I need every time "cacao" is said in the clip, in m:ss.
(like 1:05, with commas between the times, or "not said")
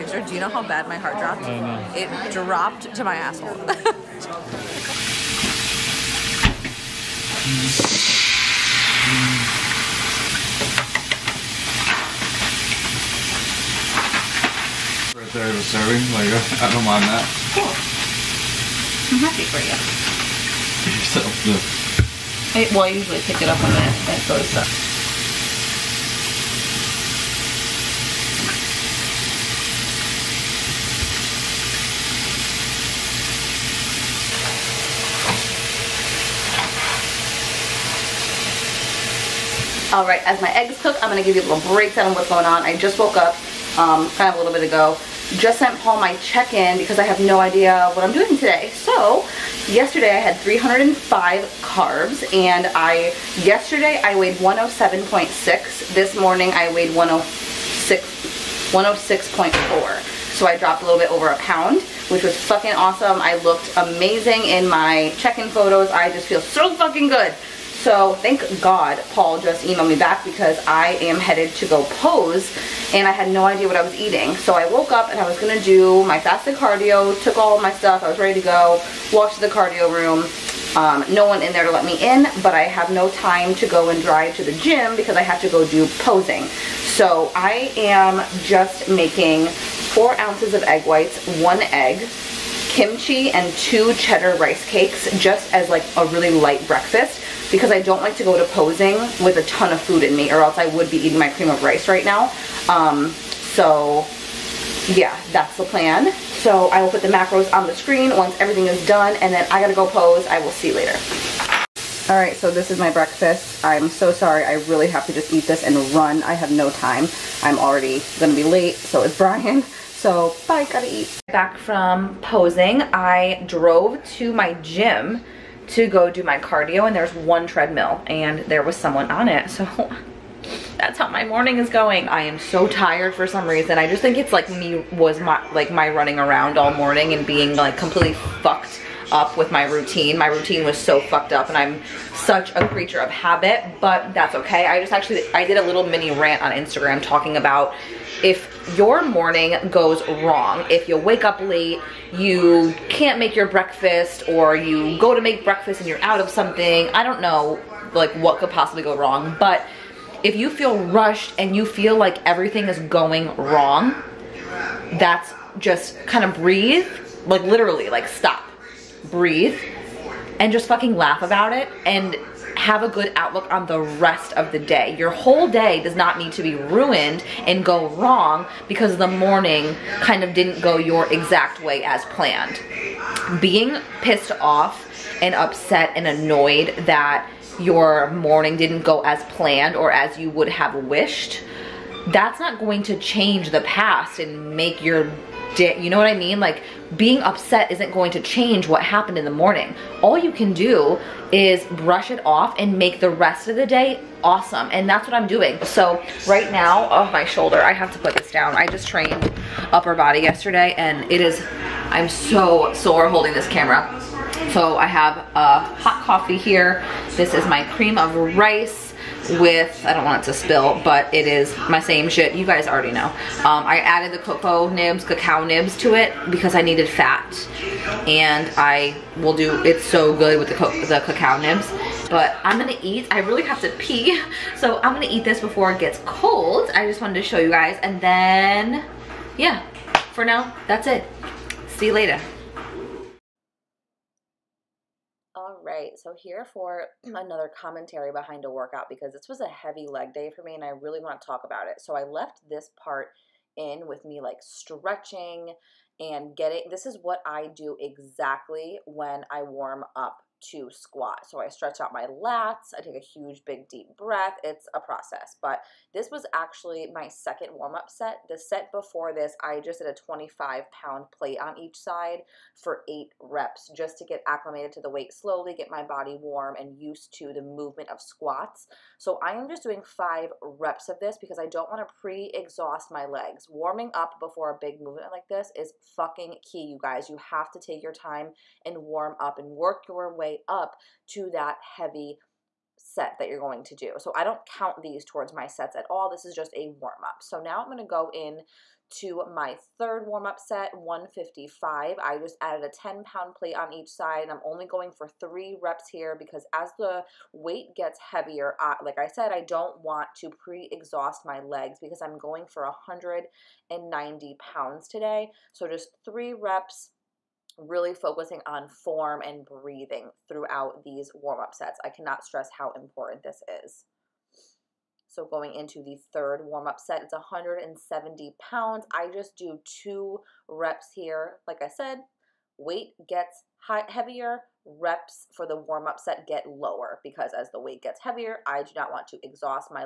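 3:45, 3:51.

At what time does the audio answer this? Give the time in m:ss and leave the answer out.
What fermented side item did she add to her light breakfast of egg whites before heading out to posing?
1:32.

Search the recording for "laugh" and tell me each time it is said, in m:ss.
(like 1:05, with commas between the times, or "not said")
2:50.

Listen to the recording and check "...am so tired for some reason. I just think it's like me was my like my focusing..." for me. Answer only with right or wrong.
wrong.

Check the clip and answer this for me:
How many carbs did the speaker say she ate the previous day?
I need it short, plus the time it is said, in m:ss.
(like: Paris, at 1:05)
305, at 0:50.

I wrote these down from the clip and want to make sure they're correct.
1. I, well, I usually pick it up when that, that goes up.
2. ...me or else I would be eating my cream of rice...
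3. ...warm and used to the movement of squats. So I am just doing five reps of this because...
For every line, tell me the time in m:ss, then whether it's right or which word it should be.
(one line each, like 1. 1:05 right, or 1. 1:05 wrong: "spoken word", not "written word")
1. 0:22 right
2. 1:40 right
3. 4:36 right.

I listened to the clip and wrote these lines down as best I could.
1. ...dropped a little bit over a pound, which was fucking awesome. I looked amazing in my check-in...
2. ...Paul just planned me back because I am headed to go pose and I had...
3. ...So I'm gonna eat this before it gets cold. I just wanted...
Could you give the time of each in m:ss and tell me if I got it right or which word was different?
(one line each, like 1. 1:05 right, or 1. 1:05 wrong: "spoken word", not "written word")
1. 1:00 right
2. 1:09 wrong: "emailed", not "planned"
3. 3:54 right.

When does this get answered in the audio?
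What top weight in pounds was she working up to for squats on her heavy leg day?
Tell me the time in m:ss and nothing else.
5:12.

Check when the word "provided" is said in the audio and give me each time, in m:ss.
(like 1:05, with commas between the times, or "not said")
not said.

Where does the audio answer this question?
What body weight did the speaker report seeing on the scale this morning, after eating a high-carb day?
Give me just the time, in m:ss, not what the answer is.
0:56.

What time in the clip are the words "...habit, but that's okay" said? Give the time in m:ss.
2:23.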